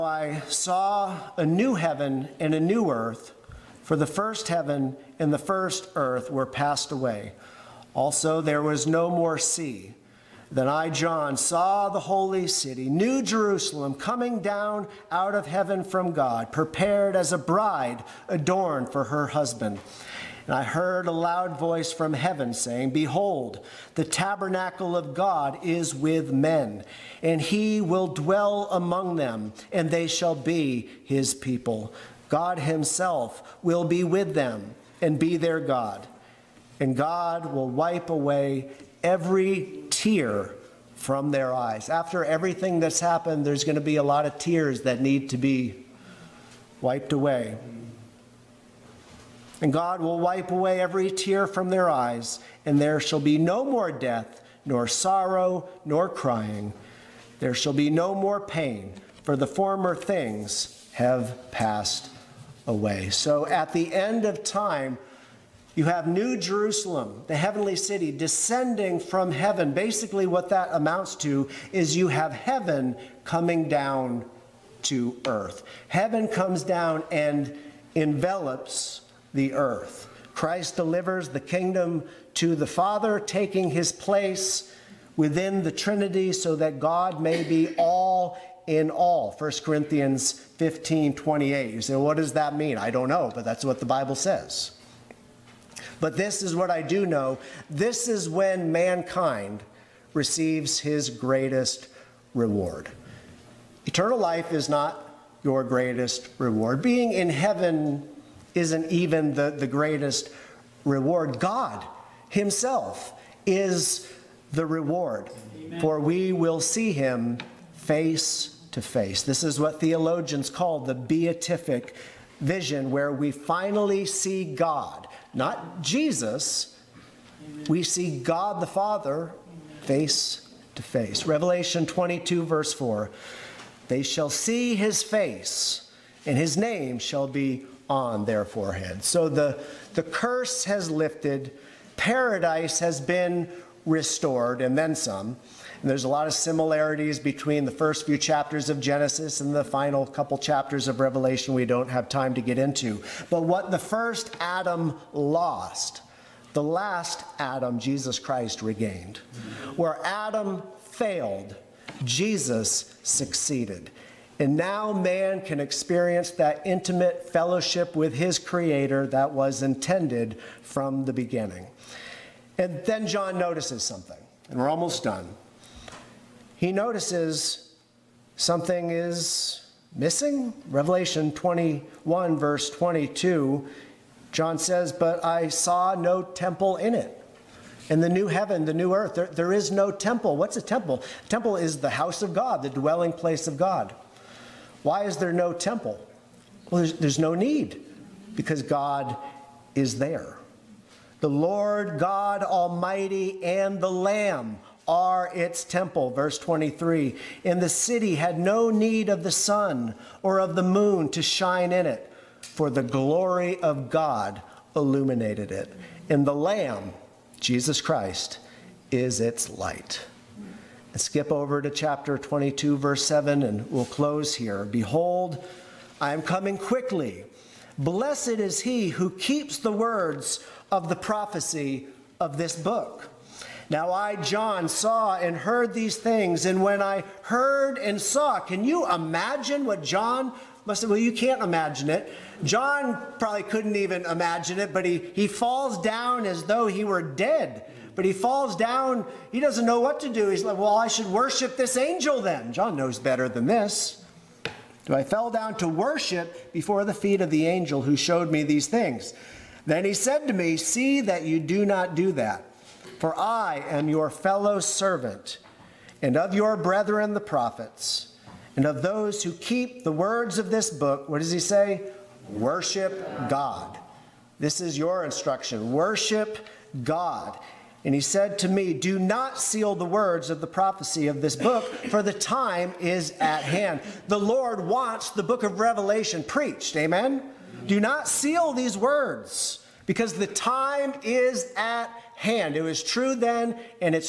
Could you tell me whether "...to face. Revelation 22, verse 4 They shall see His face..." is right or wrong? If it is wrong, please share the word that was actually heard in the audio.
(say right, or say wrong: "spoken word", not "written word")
right.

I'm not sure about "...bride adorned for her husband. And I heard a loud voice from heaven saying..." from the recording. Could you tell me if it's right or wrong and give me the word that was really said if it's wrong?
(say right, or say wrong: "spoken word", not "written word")
right.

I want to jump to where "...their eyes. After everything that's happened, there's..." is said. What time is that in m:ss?
0:41.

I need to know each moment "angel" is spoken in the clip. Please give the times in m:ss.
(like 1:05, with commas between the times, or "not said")
4:11, 4:17.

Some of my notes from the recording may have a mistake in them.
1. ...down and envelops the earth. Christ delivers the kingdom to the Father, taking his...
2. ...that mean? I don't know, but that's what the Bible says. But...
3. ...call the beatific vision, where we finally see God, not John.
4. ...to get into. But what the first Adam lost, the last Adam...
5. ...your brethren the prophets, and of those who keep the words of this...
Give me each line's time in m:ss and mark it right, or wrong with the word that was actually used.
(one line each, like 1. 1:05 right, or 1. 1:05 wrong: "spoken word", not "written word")
1. 1:16 right
2. 1:32 right
3. 2:00 wrong: "Jesus", not "John"
4. 2:32 right
5. 4:26 right.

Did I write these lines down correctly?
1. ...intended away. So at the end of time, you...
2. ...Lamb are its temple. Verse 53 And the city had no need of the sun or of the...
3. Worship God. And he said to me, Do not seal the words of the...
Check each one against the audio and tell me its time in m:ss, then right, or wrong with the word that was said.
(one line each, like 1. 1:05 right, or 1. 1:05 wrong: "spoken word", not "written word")
1. 1:01 wrong: "passed", not "intended"
2. 3:23 wrong: "23", not "53"
3. 4:35 right.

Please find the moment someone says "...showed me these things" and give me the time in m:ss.
4:17.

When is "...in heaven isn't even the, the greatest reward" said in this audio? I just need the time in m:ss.
1:47.